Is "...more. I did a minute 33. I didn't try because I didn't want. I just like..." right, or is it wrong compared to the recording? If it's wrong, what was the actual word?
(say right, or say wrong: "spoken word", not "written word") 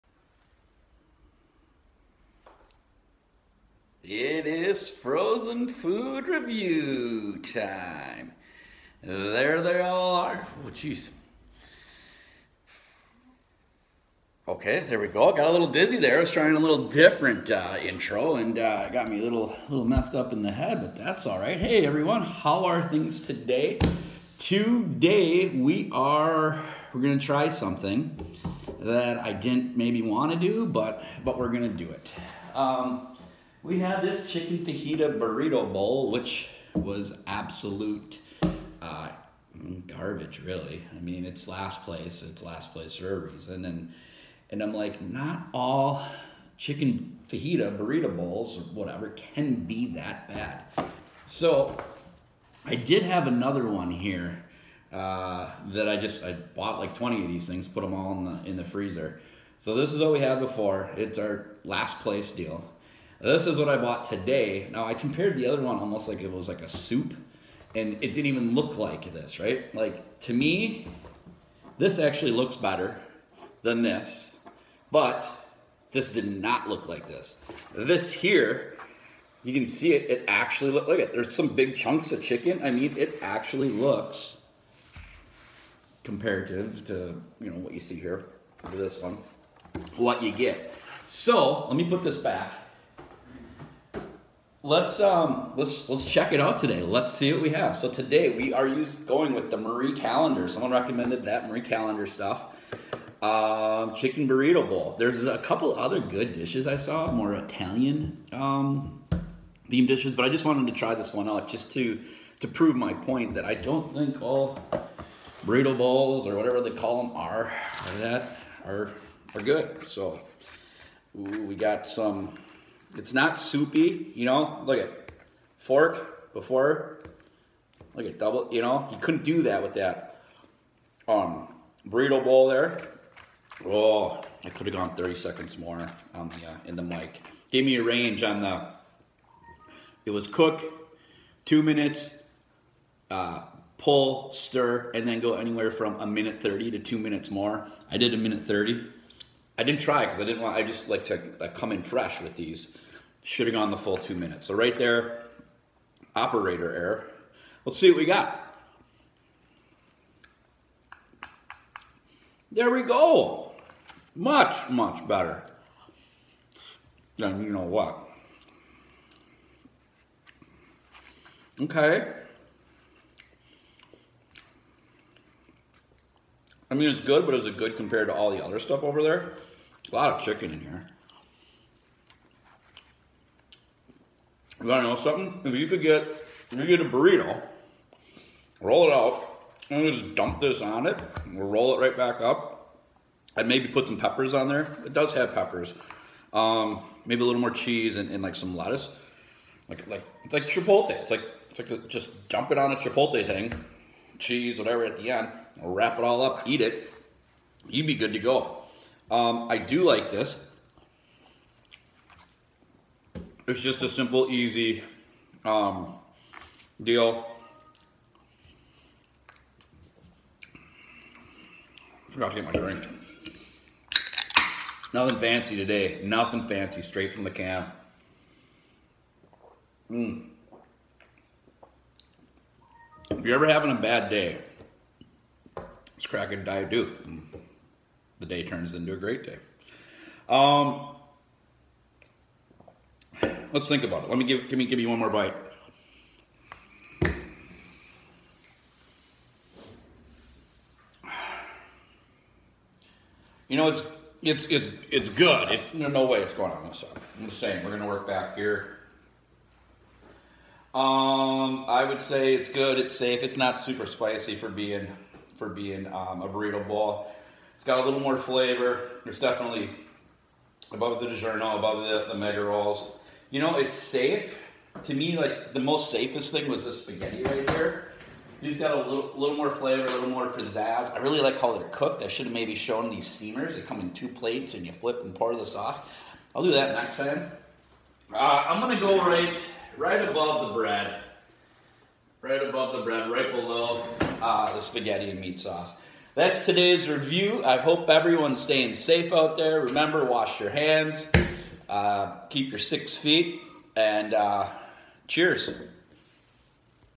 wrong: "30", not "33".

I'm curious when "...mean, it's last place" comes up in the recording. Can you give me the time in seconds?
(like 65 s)
40 s.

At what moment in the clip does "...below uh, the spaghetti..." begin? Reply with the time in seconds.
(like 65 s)
293 s.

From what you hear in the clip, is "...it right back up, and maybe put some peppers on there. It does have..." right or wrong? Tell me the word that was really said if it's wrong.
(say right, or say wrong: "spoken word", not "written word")
right.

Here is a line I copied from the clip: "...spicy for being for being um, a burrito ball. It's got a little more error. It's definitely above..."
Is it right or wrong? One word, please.
wrong.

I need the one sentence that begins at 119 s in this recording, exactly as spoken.
So ooh, we got some it's not soupy, you know?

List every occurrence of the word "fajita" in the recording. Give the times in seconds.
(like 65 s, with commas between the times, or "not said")
34 s, 47 s.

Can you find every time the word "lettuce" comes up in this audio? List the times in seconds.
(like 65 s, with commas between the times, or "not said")
198 s.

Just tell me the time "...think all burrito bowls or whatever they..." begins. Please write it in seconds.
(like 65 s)
113 s.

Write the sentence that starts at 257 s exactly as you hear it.
I'm just saying, we're gonna work back here.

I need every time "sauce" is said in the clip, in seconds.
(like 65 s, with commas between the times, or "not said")
285 s, 295 s.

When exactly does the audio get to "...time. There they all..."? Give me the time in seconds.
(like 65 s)
7 s.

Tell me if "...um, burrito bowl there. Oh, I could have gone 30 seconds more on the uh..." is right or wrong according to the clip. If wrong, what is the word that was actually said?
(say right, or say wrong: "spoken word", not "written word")
right.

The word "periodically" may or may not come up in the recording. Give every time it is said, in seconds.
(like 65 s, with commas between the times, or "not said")
not said.